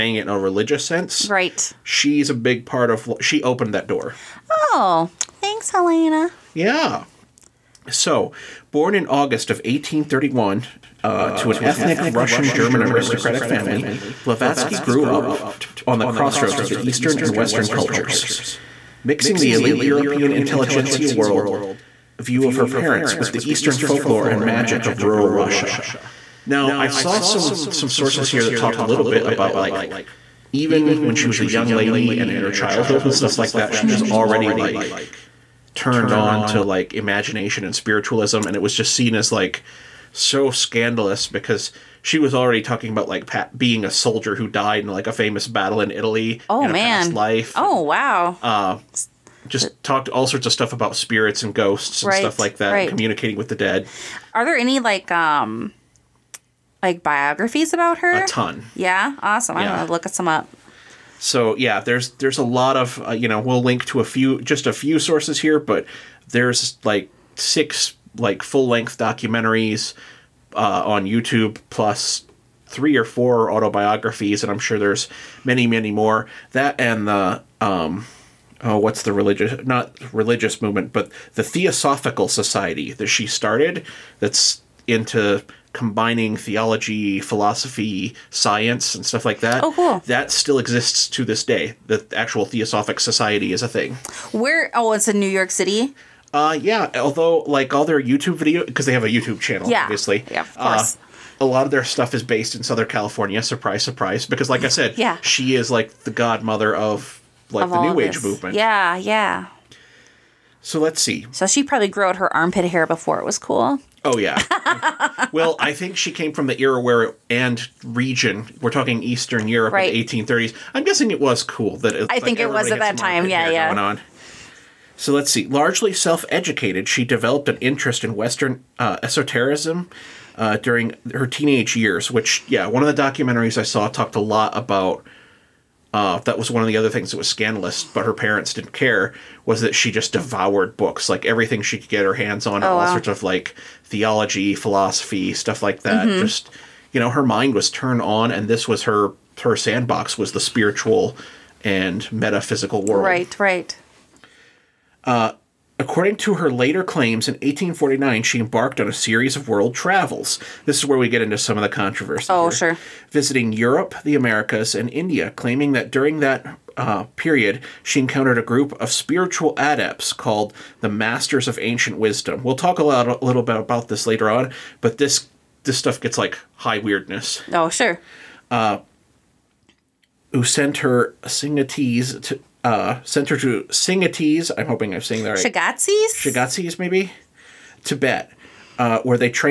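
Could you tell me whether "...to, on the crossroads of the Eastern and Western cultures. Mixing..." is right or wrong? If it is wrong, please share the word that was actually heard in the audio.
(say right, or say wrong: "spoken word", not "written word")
right.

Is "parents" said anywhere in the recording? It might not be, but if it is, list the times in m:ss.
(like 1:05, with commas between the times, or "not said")
0:22, 2:18.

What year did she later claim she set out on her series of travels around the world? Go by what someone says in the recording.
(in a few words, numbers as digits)
1849.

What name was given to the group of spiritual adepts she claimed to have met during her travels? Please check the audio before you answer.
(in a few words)
Masters of Ancient Wisdom.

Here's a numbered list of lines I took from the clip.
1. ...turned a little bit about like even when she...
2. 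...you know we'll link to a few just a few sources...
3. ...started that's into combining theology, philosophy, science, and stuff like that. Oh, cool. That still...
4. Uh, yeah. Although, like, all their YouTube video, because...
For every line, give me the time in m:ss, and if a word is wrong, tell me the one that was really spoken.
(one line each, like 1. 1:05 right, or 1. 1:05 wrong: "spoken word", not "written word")
1. 0:28 wrong: "talked", not "turned"
2. 1:03 right
3. 1:23 right
4. 1:36 right.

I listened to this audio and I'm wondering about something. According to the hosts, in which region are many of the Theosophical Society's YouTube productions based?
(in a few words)
Southern California.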